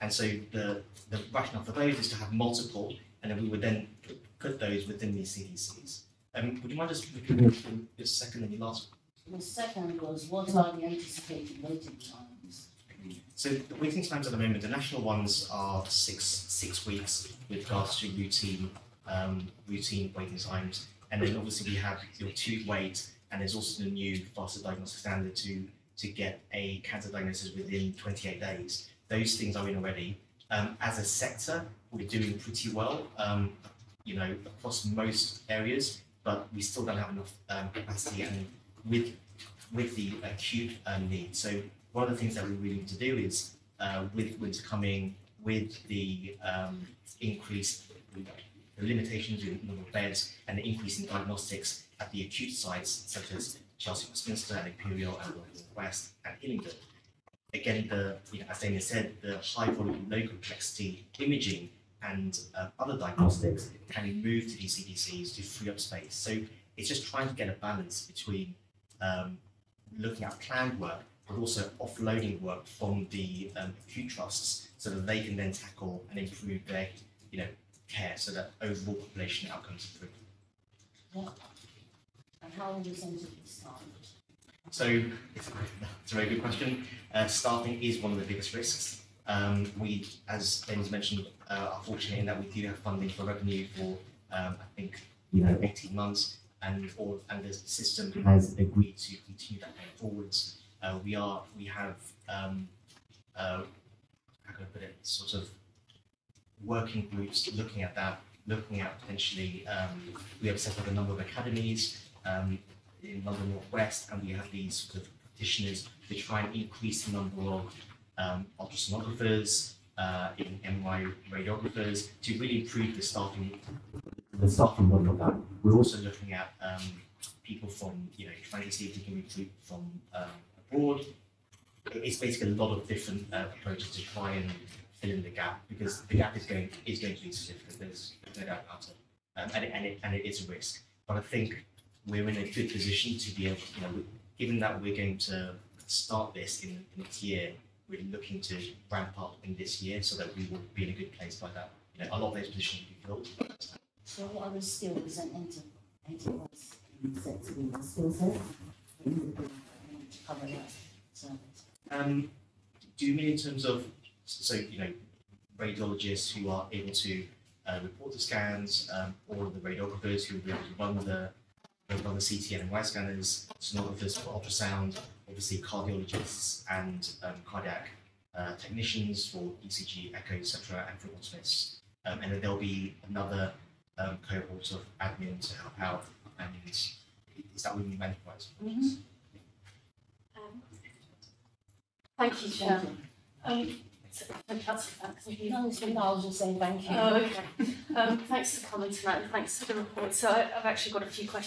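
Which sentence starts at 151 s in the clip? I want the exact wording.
You know, a lot of those positions will be filled.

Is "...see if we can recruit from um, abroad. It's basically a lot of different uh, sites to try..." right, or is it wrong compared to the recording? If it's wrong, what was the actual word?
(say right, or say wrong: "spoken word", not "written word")
wrong: "approaches", not "sites".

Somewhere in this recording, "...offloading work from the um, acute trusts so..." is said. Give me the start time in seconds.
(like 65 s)
71 s.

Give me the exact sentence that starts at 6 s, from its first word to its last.
Um, would you mind just repeating your second and your last?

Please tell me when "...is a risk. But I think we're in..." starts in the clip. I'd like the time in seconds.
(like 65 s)
140 s.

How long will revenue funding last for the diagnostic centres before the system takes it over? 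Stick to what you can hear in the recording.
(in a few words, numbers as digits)
18 months.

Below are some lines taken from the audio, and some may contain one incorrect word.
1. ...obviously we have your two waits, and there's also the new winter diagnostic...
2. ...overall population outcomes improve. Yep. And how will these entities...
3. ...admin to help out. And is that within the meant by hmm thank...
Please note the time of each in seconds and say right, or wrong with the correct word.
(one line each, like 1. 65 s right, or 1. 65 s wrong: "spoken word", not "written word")
1. 21 s wrong: "faster", not "winter"
2. 78 s right
3. 185 s right.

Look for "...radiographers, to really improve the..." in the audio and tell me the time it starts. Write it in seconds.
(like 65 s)
121 s.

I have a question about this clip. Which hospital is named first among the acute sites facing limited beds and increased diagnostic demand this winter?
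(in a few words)
Chelsea Westminster.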